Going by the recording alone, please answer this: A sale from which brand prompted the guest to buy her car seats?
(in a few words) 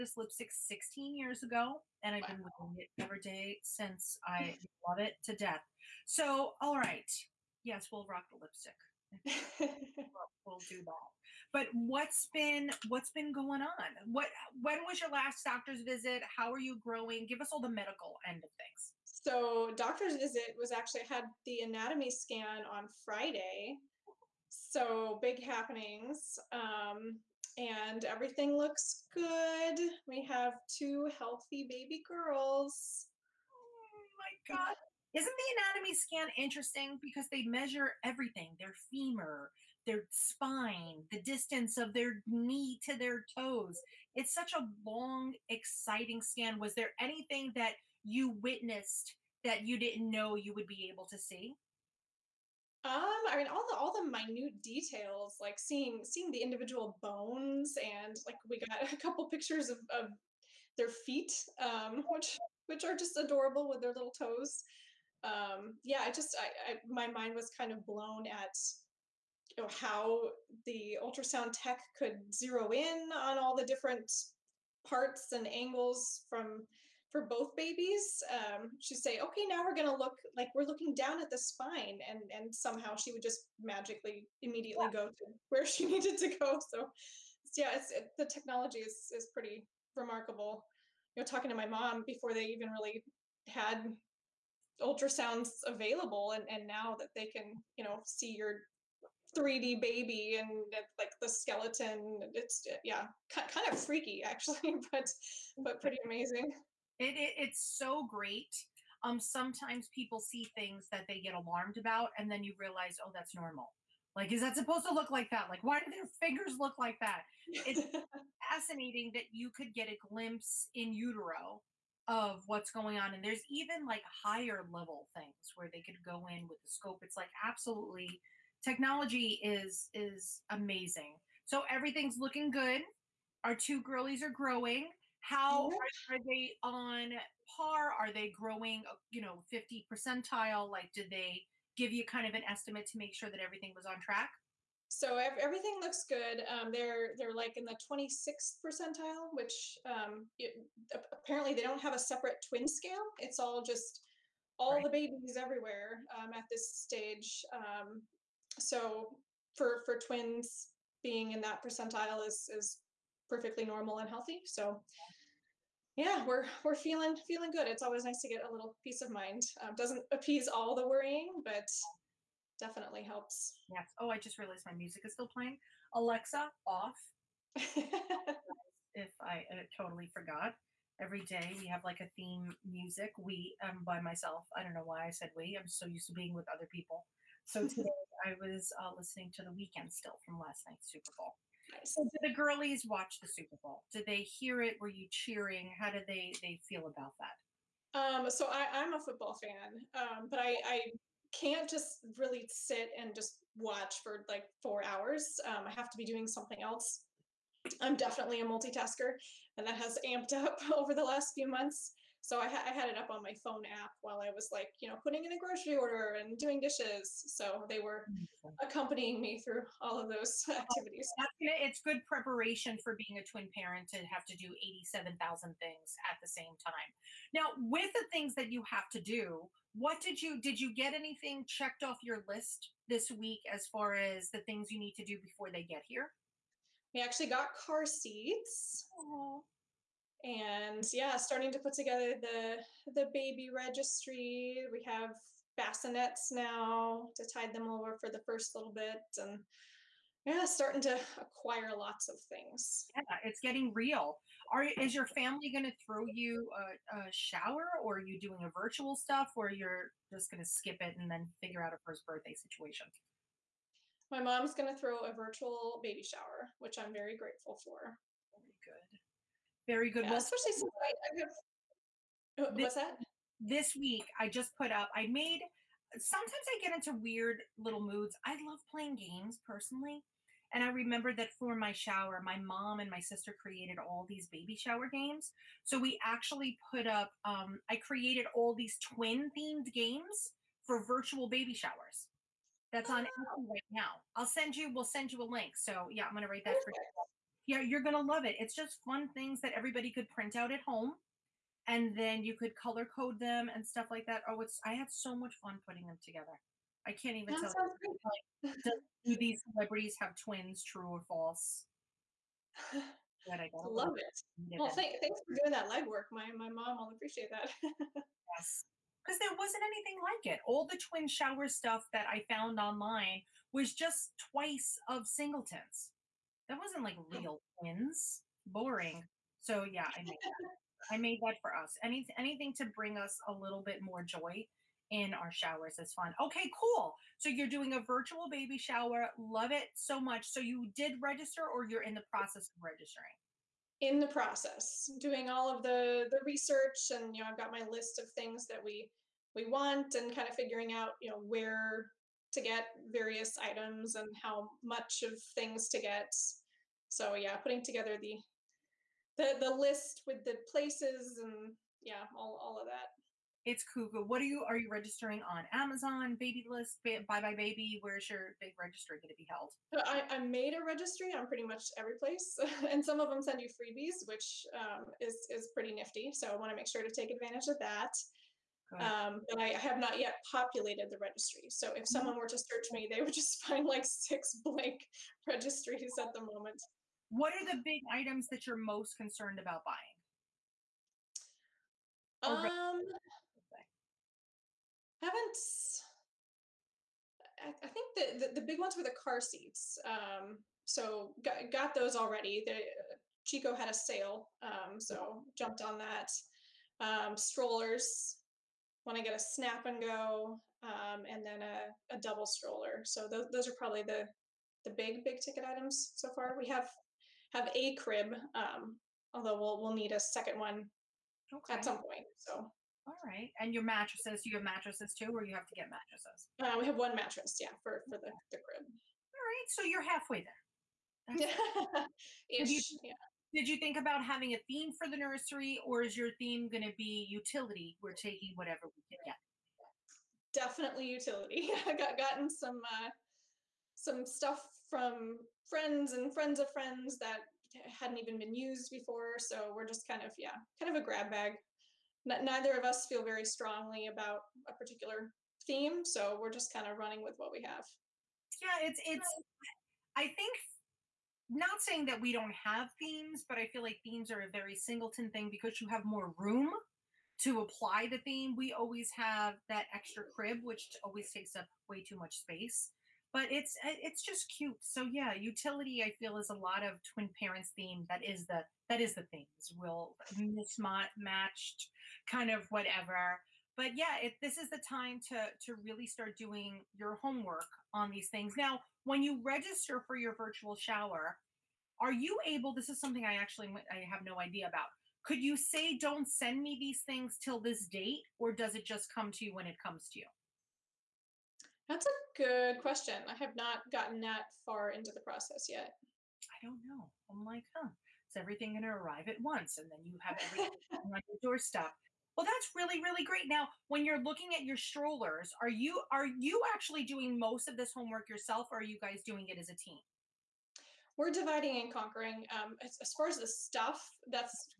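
Chicco.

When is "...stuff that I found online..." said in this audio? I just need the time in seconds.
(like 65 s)
321 s.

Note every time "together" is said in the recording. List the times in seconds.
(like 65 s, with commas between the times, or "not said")
241 s, 306 s, 357 s.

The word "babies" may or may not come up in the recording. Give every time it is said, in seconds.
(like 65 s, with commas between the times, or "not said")
77 s, 154 s.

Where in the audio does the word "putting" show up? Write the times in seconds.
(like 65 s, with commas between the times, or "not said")
214 s, 305 s, 357 s.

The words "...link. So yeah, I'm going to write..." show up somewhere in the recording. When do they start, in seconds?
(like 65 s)
295 s.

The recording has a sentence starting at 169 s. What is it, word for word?
Um, doesn't appease all the worrying, but definitely helps.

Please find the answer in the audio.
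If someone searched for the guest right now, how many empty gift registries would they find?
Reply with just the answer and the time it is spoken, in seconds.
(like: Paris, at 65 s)
6, at 383 s.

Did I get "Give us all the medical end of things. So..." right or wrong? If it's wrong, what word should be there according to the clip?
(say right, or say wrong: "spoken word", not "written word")
right.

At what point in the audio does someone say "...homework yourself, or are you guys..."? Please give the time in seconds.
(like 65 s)
517 s.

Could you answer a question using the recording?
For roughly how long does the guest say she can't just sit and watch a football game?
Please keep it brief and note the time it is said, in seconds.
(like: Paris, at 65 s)
4 hours, at 204 s.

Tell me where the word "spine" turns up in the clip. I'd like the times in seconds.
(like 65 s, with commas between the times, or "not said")
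40 s, 81 s.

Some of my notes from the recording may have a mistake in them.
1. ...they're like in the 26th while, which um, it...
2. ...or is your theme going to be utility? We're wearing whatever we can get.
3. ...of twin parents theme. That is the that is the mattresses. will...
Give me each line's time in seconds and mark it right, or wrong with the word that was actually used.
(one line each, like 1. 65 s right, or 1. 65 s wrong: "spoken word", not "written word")
1. 147 s wrong: "percentile", not "while"
2. 435 s wrong: "taking", not "wearing"
3. 476 s wrong: "themes", not "mattresses".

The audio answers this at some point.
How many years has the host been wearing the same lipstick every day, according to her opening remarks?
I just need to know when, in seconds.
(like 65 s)
0 s.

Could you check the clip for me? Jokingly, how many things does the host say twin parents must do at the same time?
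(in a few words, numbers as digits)
87,000.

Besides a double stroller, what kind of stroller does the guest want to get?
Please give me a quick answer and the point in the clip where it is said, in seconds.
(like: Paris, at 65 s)
snap and go, at 409 s.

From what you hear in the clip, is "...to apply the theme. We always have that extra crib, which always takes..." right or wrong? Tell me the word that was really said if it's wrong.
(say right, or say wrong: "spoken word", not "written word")
right.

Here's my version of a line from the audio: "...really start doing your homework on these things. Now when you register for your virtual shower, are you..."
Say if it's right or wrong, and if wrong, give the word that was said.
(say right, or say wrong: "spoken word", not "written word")
right.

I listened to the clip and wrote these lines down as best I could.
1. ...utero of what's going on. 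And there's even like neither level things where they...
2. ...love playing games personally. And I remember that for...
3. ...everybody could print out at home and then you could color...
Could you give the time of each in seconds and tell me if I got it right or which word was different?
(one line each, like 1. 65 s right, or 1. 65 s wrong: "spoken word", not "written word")
1. 120 s wrong: "higher", not "neither"
2. 278 s right
3. 299 s right.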